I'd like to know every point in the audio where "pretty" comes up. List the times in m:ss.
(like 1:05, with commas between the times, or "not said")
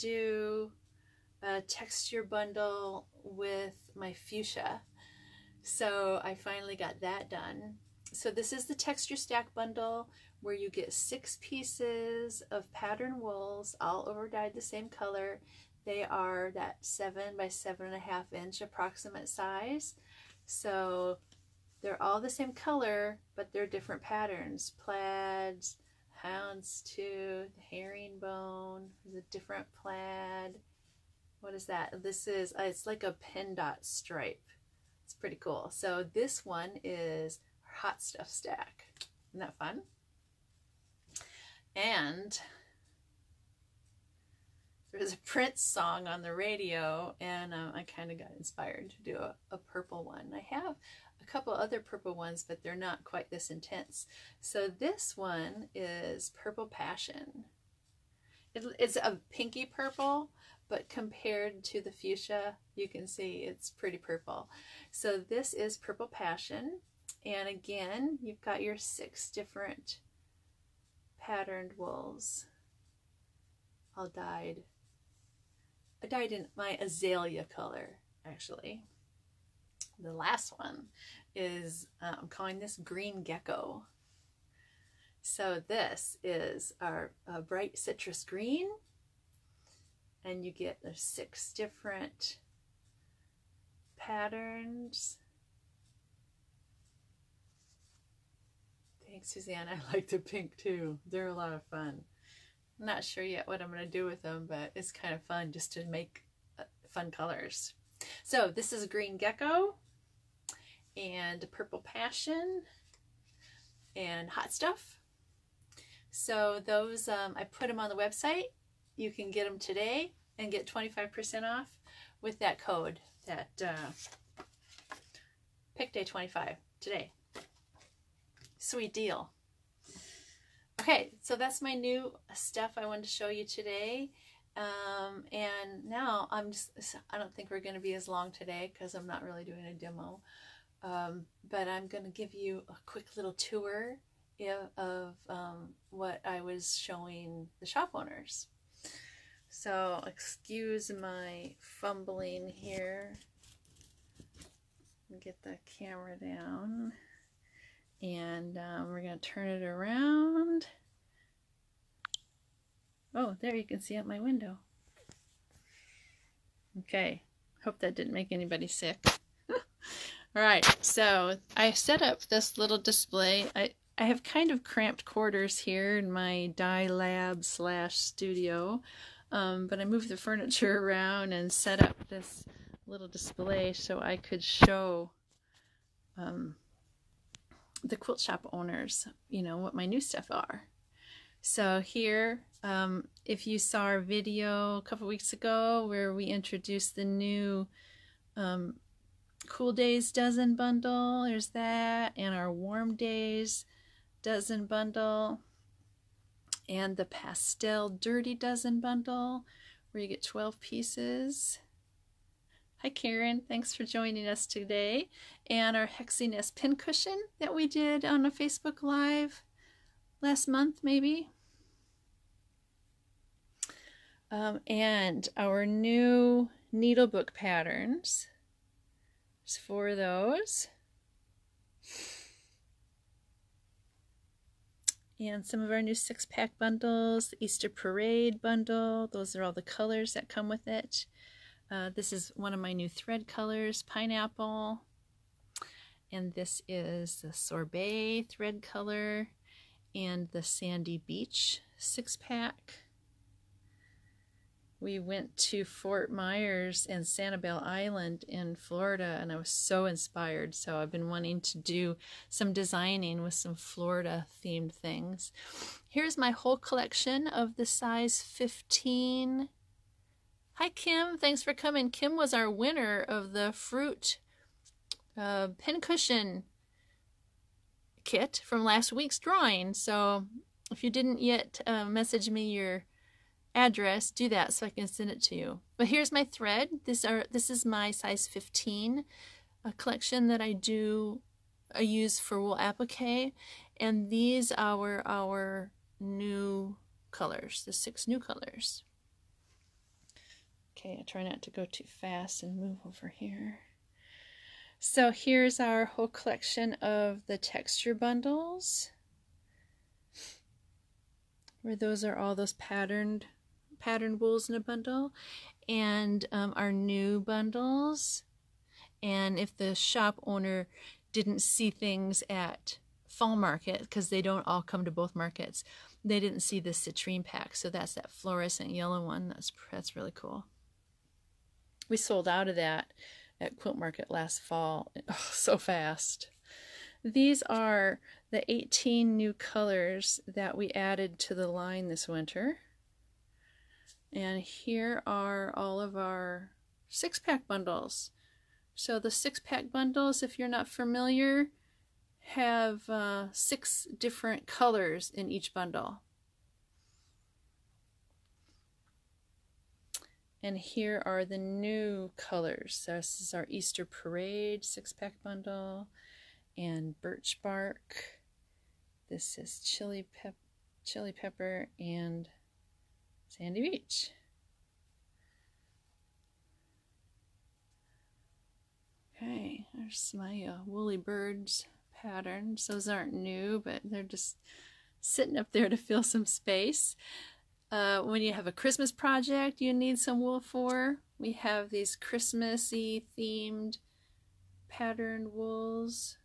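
0:35, 1:03.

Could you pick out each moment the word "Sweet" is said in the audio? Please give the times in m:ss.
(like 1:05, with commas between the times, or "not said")
2:08.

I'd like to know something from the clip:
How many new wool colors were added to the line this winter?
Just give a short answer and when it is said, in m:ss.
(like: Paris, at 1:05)
18, at 5:38.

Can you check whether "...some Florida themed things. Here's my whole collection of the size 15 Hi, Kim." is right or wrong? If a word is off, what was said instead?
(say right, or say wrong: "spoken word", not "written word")
right.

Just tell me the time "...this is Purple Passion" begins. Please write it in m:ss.
1:05.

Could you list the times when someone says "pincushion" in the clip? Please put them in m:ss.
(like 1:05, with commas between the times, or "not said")
3:36, 4:35.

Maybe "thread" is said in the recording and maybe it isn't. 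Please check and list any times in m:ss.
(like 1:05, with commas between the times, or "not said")
4:02, 4:08, 4:46.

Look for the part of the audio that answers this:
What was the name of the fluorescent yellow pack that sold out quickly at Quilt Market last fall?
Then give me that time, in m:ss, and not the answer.
5:26.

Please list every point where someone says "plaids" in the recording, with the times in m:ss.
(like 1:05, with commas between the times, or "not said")
0:24, 0:29.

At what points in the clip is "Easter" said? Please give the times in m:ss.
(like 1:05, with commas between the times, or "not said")
3:57, 6:03.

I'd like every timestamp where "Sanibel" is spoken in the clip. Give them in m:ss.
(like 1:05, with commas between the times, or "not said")
4:17.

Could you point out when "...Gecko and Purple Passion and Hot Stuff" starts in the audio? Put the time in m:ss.
1:49.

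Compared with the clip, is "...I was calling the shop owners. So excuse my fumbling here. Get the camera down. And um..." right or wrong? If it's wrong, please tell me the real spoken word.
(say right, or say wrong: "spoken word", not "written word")
wrong: "showing", not "calling".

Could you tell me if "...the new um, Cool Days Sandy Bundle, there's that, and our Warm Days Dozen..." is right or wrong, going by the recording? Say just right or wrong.
wrong.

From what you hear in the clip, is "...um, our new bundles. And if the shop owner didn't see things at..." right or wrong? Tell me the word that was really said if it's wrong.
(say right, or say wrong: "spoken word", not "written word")
right.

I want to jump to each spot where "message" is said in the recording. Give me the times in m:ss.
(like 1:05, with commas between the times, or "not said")
4:41.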